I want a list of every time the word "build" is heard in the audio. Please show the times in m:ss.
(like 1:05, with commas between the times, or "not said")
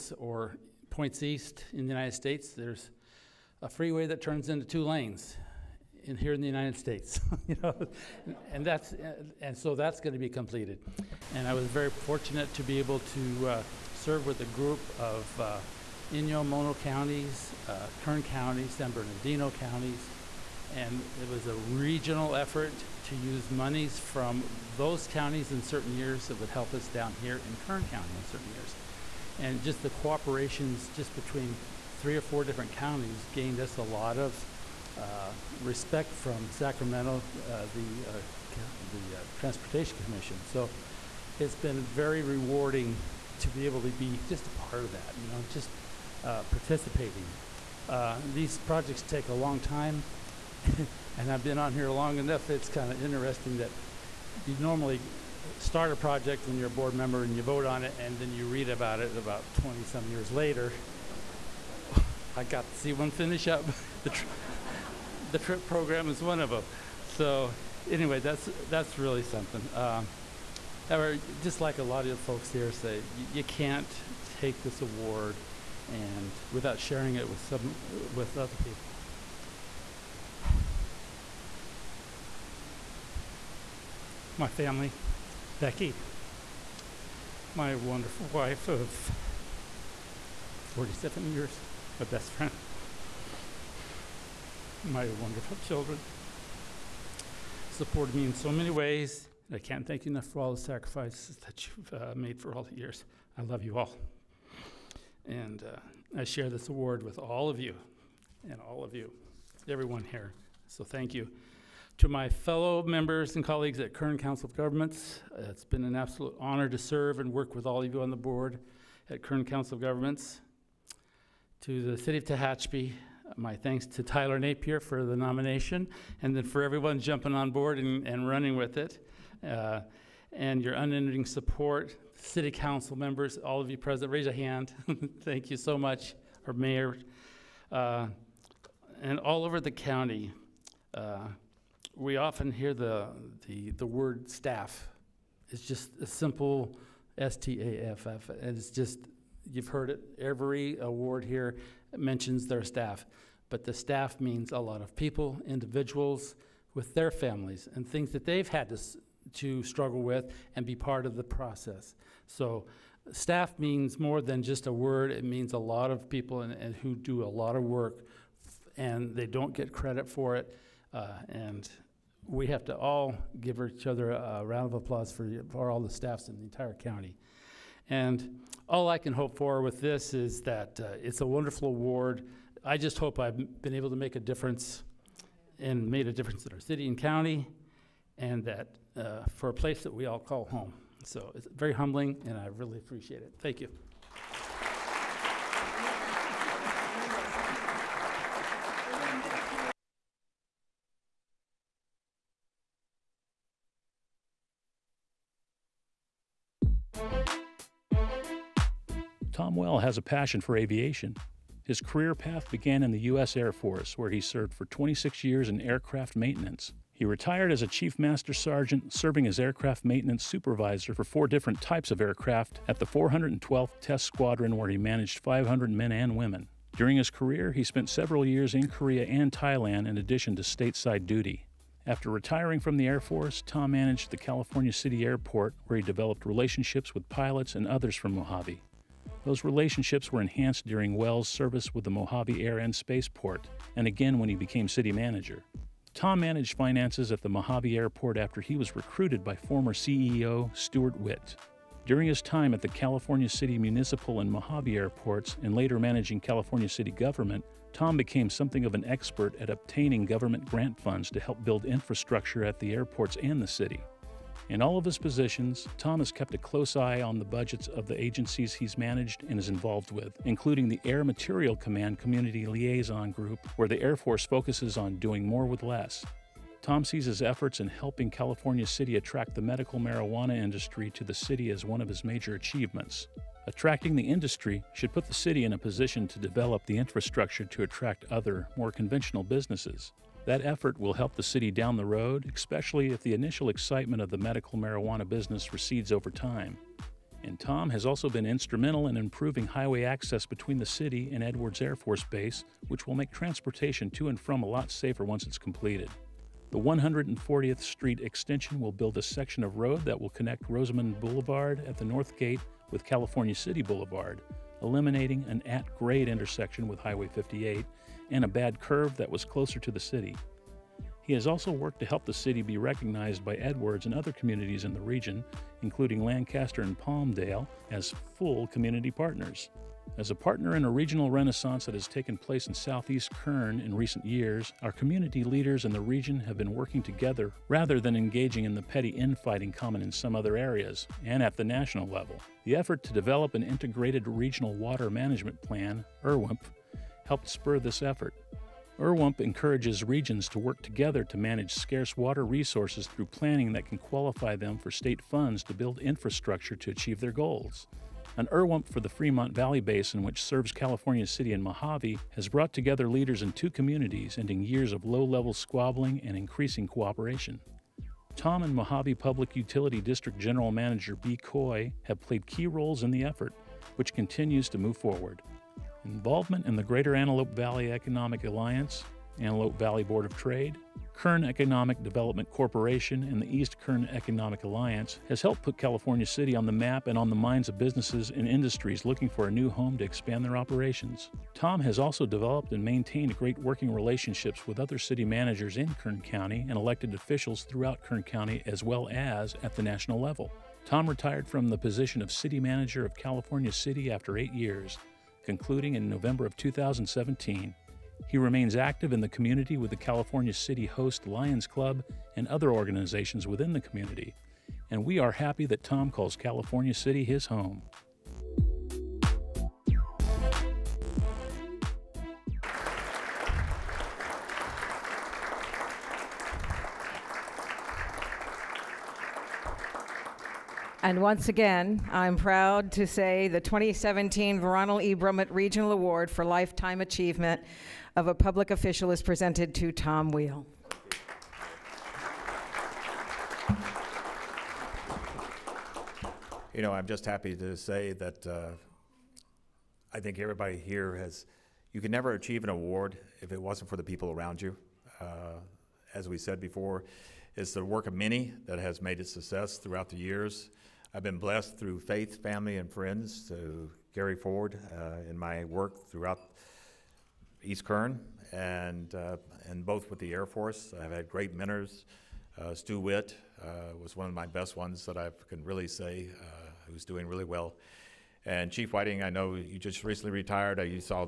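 4:21, 5:08, 5:55.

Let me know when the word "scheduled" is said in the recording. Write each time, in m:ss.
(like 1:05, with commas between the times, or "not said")
not said.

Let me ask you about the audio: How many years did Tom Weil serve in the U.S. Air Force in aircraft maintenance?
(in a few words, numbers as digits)
26.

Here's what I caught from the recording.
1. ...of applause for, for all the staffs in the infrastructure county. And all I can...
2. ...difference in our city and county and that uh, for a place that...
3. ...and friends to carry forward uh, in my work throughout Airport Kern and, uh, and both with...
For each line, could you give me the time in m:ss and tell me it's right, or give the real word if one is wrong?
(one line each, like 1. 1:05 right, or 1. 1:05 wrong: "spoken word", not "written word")
1. 2:54 wrong: "entire", not "infrastructure"
2. 3:06 right
3. 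7:42 wrong: "East", not "Airport".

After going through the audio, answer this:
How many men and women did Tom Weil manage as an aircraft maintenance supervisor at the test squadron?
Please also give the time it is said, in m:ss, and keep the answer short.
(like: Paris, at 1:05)
500, at 3:45.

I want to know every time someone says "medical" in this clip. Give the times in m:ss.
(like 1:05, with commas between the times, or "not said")
4:39, 4:54.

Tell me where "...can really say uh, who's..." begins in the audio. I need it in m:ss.
7:55.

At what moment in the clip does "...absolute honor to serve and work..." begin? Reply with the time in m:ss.
1:55.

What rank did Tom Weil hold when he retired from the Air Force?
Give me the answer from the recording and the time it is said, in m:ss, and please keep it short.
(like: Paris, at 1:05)
Chief Master Sergeant, at 3:37.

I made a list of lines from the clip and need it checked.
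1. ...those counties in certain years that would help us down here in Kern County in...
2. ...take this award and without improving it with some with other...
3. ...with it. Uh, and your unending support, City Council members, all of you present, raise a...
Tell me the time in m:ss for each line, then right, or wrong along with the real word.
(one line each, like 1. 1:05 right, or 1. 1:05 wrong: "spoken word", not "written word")
1. 0:24 right
2. 1:14 wrong: "sharing", not "improving"
3. 2:08 right.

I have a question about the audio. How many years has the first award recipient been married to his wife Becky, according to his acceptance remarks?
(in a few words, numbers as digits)
47.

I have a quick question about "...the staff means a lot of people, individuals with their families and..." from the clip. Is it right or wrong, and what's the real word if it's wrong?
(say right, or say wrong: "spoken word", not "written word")
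right.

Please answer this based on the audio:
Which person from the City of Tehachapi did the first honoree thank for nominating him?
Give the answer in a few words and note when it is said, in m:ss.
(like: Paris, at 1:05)
Tyler Napier, at 2:04.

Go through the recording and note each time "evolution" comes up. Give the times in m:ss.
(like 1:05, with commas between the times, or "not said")
not said.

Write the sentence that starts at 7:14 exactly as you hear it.
Brummett Regional Award for Lifetime Achievement of a Public Official is presented to Tom Weil.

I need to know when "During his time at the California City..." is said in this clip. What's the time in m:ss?
4:11.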